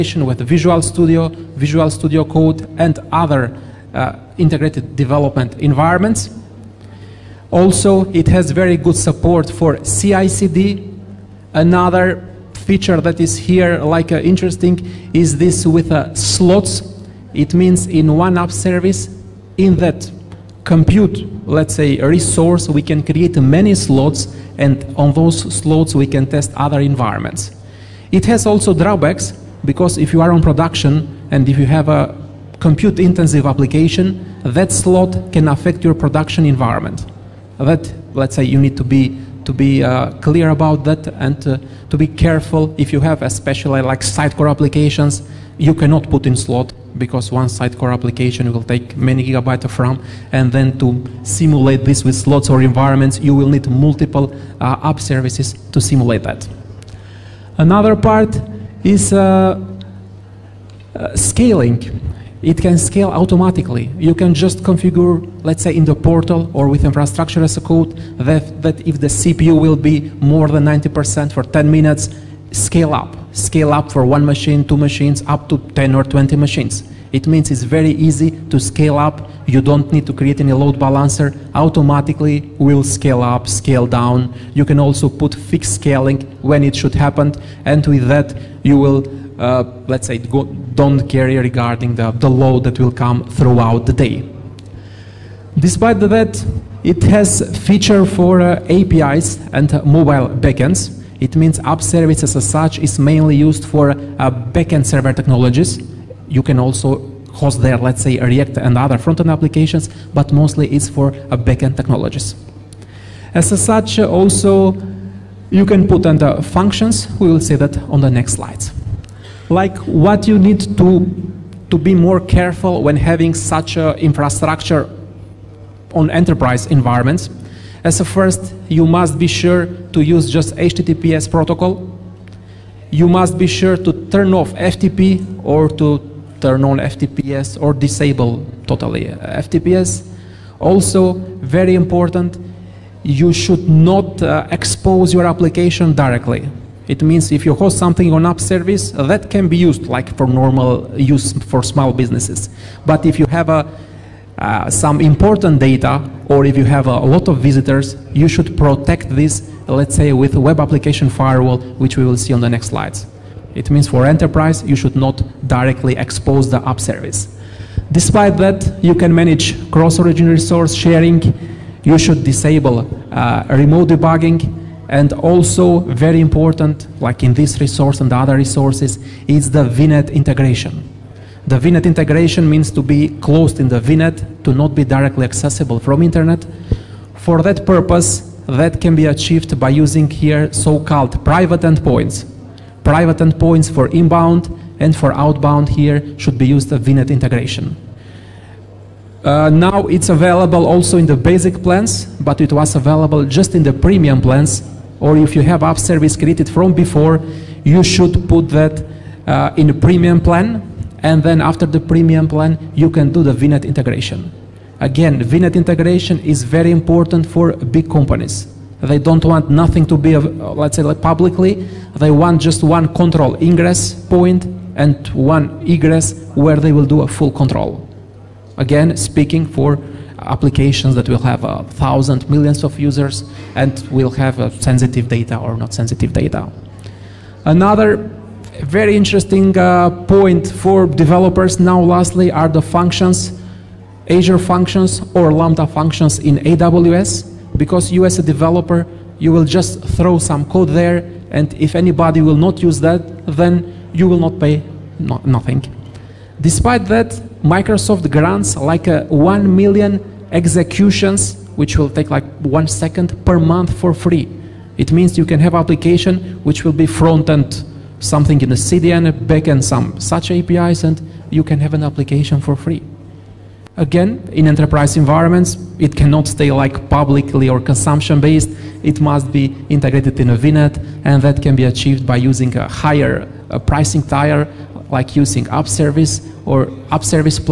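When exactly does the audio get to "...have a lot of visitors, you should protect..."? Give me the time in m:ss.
2:36.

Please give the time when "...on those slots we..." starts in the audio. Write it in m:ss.
0:24.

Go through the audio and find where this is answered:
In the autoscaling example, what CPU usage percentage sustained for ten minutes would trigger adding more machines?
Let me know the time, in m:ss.
1:10.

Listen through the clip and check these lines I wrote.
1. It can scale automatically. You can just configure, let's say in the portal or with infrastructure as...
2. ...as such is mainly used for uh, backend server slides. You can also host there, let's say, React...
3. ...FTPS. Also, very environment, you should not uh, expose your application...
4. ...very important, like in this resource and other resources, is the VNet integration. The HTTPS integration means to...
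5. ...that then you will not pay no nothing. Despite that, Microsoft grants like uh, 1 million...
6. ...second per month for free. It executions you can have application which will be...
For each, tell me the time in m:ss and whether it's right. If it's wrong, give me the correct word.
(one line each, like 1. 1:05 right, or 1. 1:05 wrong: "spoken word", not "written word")
1. 1:02 right
2. 1:42 wrong: "technologies", not "slides"
3. 2:19 wrong: "important", not "environment"
4. 2:55 wrong: "VNet", not "HTTPS"
5. 4:12 right
6. 4:22 wrong: "means", not "executions".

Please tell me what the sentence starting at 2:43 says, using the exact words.
It means for enterprise, you should not directly expose the app service.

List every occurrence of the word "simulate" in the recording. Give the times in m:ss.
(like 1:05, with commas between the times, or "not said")
0:51, 0:55.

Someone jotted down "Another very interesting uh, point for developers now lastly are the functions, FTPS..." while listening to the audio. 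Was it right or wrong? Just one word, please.
wrong.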